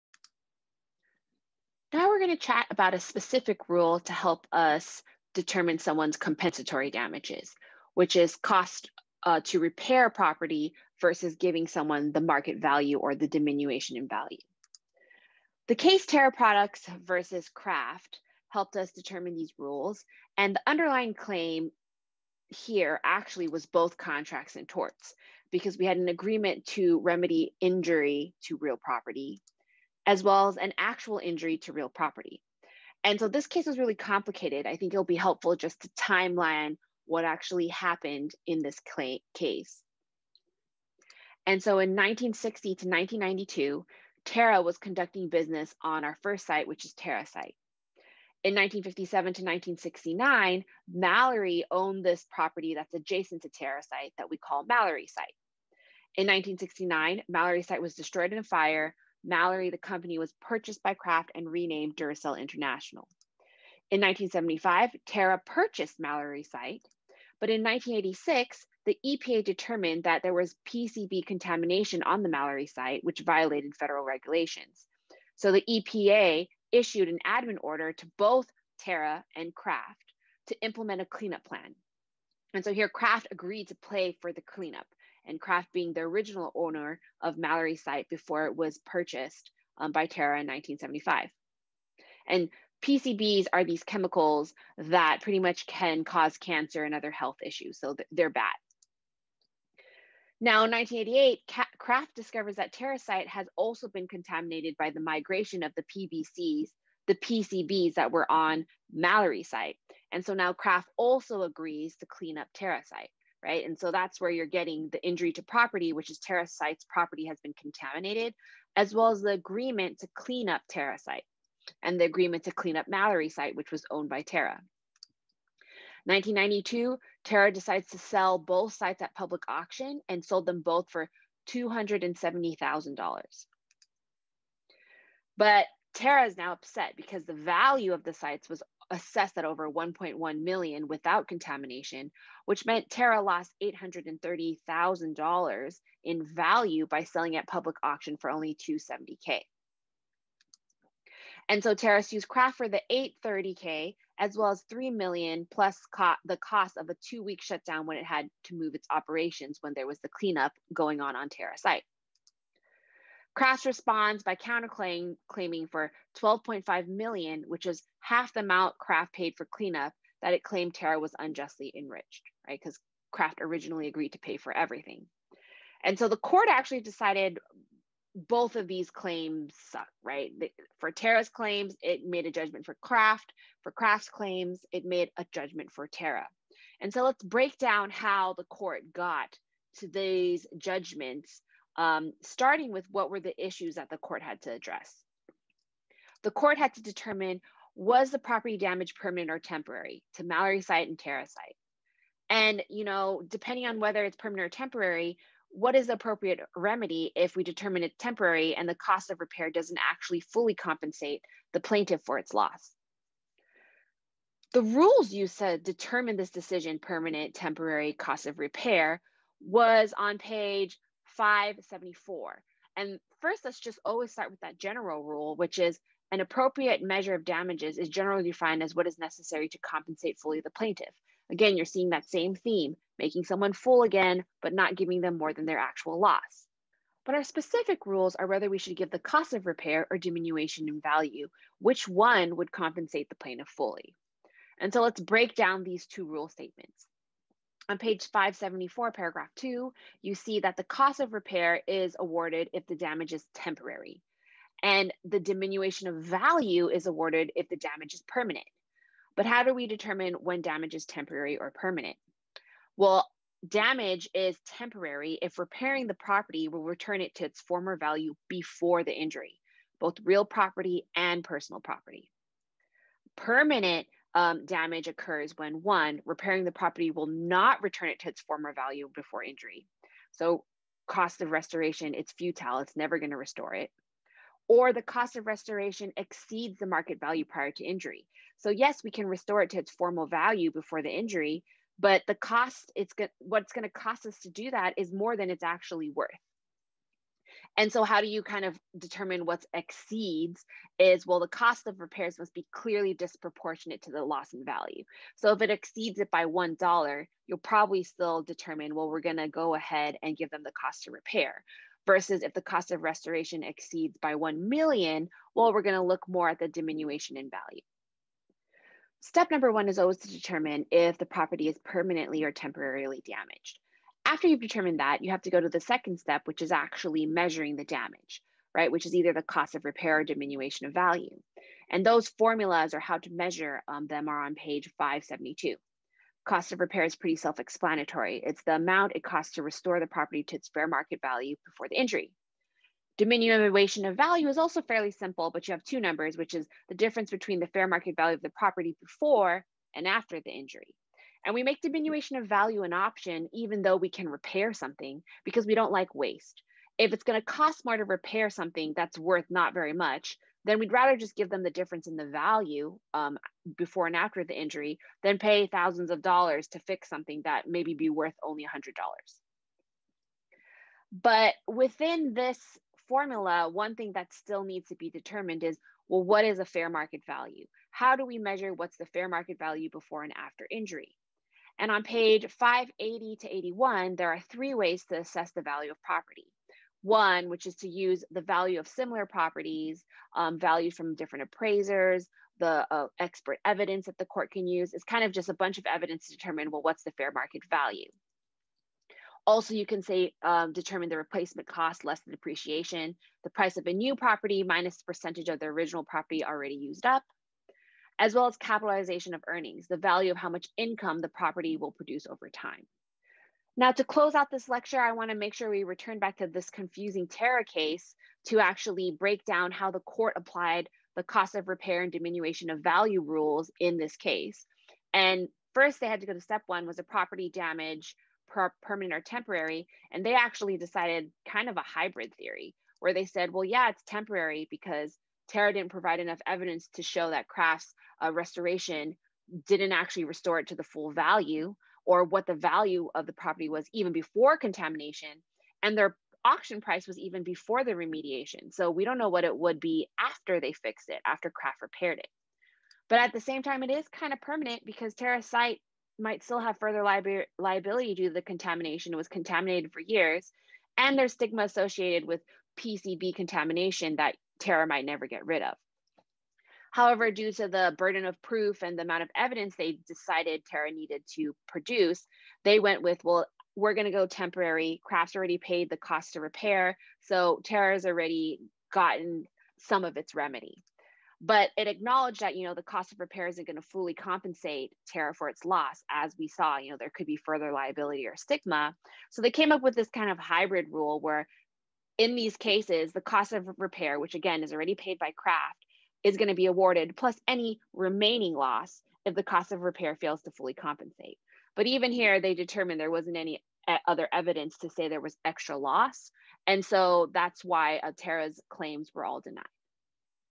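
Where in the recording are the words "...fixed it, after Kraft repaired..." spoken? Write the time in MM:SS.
07:30.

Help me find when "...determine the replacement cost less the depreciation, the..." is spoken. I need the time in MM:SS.
06:40.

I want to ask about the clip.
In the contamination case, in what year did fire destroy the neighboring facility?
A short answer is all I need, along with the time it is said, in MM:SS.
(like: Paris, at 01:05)
1969, at 00:56.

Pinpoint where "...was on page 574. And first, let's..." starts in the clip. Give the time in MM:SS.
03:39.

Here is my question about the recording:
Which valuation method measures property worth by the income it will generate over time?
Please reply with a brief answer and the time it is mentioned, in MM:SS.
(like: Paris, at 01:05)
capitalization of earnings, at 06:48.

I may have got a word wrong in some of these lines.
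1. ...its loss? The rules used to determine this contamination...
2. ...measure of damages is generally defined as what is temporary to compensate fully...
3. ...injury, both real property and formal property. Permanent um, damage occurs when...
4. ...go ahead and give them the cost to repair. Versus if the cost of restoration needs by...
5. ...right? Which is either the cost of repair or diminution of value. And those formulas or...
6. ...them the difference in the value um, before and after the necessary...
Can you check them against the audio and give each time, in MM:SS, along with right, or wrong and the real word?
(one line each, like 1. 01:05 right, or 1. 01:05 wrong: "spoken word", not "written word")
1. 03:32 wrong: "decision", not "contamination"
2. 03:46 wrong: "necessary", not "temporary"
3. 04:28 wrong: "personal", not "formal"
4. 05:09 wrong: "exceeds", not "needs"
5. 05:28 right
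6. 06:01 wrong: "injury", not "necessary".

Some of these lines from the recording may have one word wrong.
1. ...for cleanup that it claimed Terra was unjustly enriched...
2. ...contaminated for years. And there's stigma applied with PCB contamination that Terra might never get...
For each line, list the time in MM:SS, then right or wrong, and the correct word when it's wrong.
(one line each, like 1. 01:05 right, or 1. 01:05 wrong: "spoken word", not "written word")
1. 02:49 right
2. 07:39 wrong: "associated", not "applied".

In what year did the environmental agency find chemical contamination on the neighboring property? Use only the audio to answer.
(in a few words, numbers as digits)
1986.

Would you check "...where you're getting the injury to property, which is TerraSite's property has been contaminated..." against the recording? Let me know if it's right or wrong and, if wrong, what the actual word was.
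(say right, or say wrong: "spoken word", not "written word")
right.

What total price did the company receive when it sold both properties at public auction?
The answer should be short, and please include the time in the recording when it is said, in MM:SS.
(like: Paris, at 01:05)
$270,000, at 02:11.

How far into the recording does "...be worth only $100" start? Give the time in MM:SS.
06:07.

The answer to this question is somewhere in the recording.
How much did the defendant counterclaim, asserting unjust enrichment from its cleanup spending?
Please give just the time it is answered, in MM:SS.
02:46.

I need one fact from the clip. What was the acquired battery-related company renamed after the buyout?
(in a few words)
Duracell International.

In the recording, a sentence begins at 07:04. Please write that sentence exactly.
And first, they had to go to step one was a property damage, per permanent or temporary.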